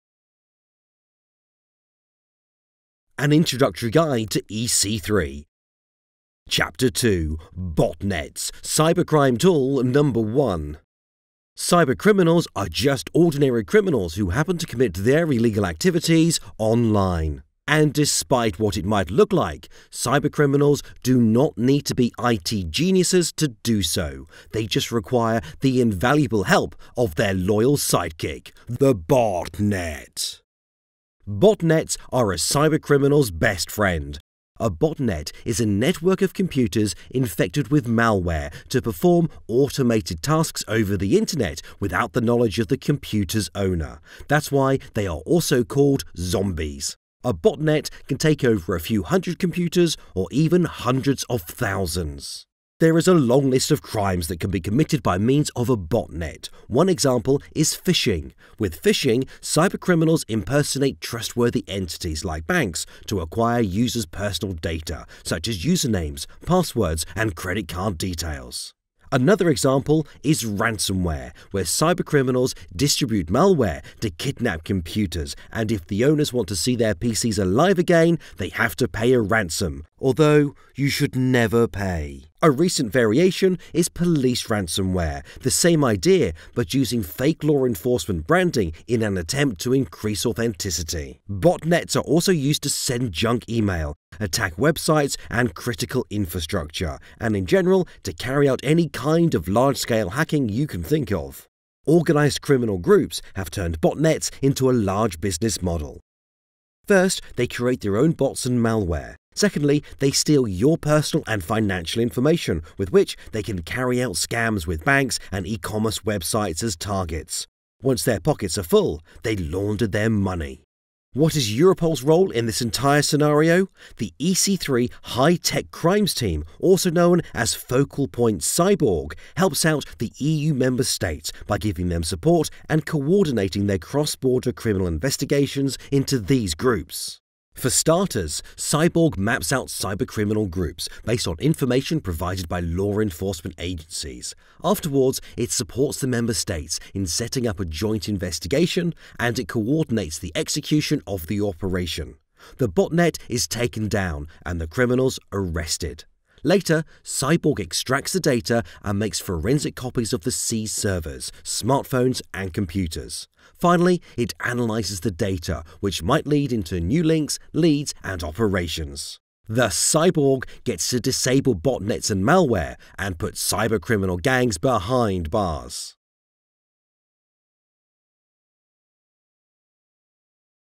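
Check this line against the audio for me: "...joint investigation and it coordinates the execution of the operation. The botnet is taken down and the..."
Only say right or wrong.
right.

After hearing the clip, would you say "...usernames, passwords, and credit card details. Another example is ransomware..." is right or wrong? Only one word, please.
right.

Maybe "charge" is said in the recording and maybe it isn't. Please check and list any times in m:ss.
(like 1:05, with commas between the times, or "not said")
not said.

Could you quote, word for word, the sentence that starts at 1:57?
Once their pockets are full, they launder their money.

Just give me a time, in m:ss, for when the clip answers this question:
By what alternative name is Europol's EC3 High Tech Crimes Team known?
2:07.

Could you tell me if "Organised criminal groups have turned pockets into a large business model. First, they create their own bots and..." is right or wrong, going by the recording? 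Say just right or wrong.
wrong.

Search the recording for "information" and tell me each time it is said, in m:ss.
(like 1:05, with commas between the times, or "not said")
1:52, 2:21.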